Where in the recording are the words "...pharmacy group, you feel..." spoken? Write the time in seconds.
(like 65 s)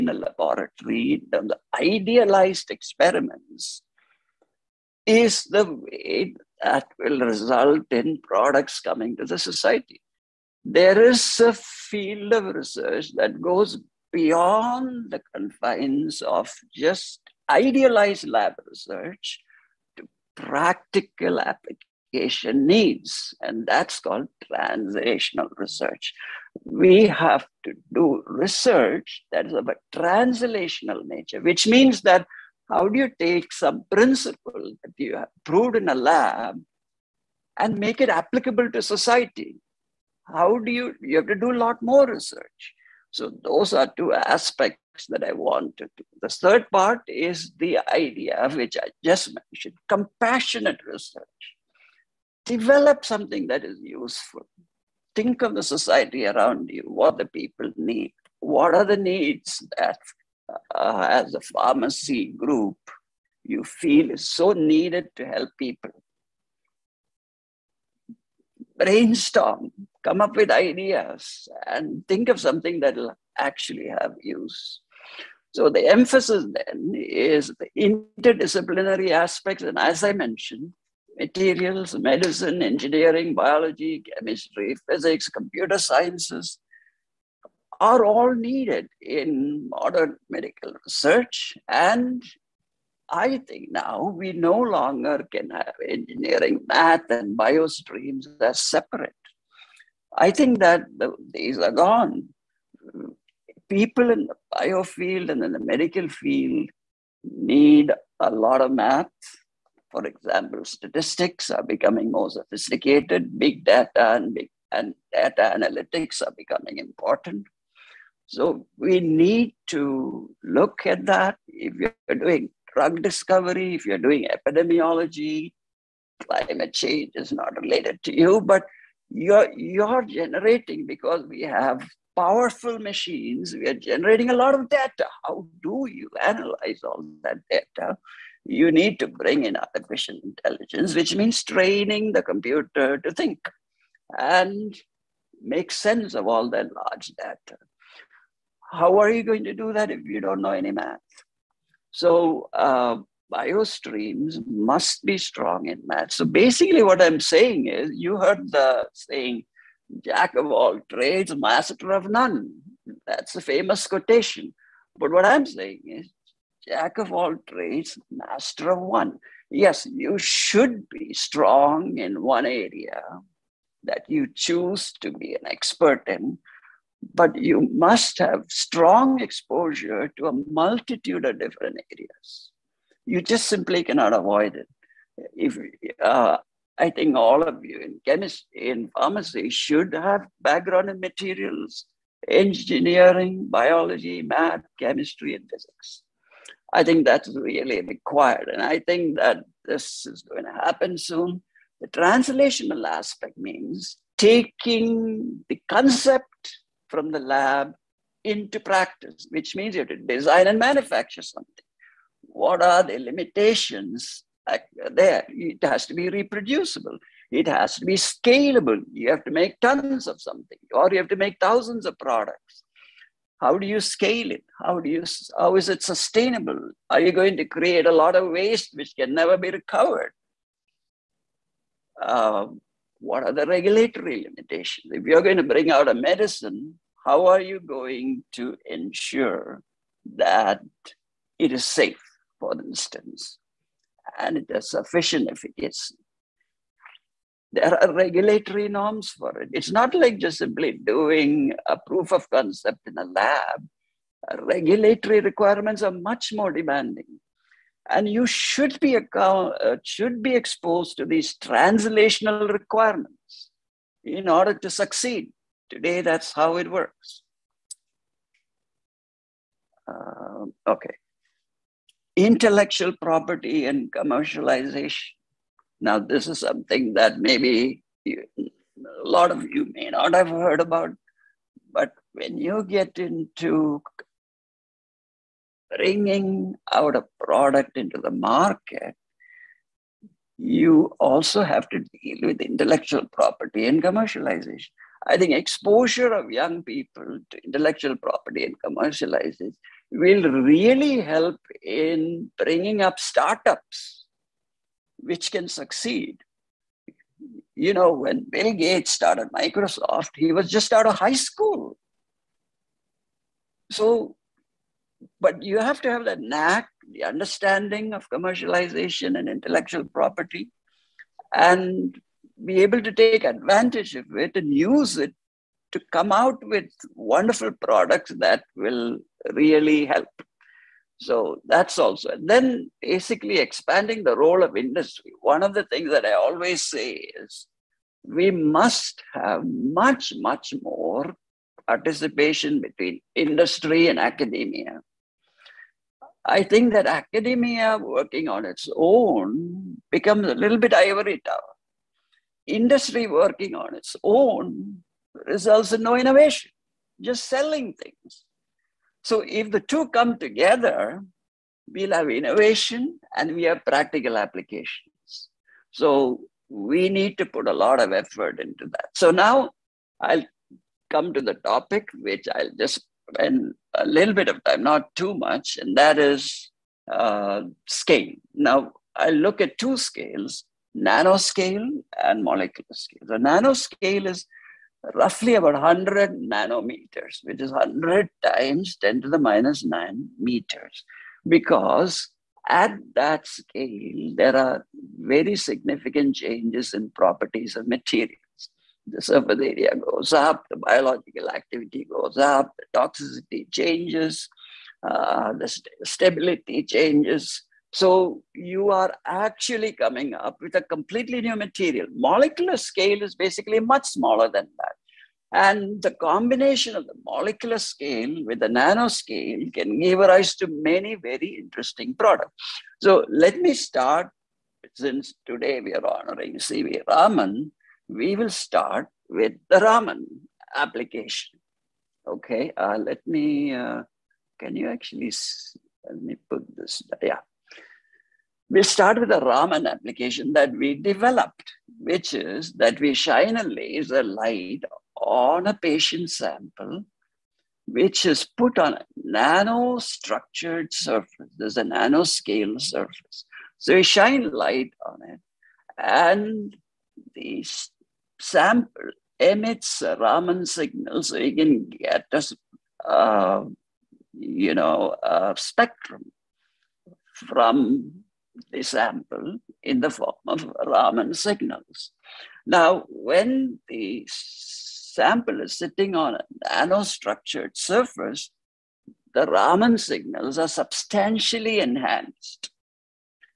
61 s.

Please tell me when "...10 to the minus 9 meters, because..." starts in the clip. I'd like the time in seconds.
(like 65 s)
388 s.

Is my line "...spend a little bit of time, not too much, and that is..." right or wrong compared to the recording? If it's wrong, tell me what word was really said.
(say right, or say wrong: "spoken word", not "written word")
right.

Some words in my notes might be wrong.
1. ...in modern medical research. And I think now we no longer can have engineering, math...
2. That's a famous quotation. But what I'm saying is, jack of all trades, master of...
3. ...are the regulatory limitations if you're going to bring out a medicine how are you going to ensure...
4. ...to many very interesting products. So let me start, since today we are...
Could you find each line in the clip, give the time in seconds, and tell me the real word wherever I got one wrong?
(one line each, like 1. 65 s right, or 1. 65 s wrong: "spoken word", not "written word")
1. 88 s right
2. 163 s right
3. 233 s right
4. 420 s right.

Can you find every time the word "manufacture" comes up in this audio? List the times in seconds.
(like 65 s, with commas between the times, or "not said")
210 s.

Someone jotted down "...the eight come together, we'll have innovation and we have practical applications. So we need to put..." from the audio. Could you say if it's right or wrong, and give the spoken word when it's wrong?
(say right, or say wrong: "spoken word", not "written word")
wrong: "two", not "eight".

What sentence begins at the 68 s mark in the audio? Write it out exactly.
Brainstorm, come up with ideas, and think of something that will actually have use.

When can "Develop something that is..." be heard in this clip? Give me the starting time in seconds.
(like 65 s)
52 s.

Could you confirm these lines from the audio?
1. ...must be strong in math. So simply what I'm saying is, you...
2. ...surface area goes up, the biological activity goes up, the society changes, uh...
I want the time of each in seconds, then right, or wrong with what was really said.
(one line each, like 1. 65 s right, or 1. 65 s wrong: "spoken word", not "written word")
1. 154 s wrong: "basically", not "simply"
2. 398 s wrong: "toxicity", not "society".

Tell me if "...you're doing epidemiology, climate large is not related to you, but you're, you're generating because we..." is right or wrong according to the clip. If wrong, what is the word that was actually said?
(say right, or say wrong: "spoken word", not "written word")
wrong: "change", not "large".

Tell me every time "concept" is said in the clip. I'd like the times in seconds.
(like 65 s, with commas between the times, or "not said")
205 s, 252 s.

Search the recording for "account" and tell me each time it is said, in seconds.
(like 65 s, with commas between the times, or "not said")
258 s.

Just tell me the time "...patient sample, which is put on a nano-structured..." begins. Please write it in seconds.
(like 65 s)
445 s.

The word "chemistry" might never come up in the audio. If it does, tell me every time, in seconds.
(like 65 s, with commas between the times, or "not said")
84 s, 188 s, 194 s.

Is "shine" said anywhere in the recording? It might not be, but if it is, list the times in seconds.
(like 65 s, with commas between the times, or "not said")
442 s, 453 s.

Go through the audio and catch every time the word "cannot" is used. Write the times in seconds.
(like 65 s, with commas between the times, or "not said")
183 s.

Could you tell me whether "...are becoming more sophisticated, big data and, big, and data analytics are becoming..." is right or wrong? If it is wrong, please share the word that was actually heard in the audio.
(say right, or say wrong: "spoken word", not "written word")
right.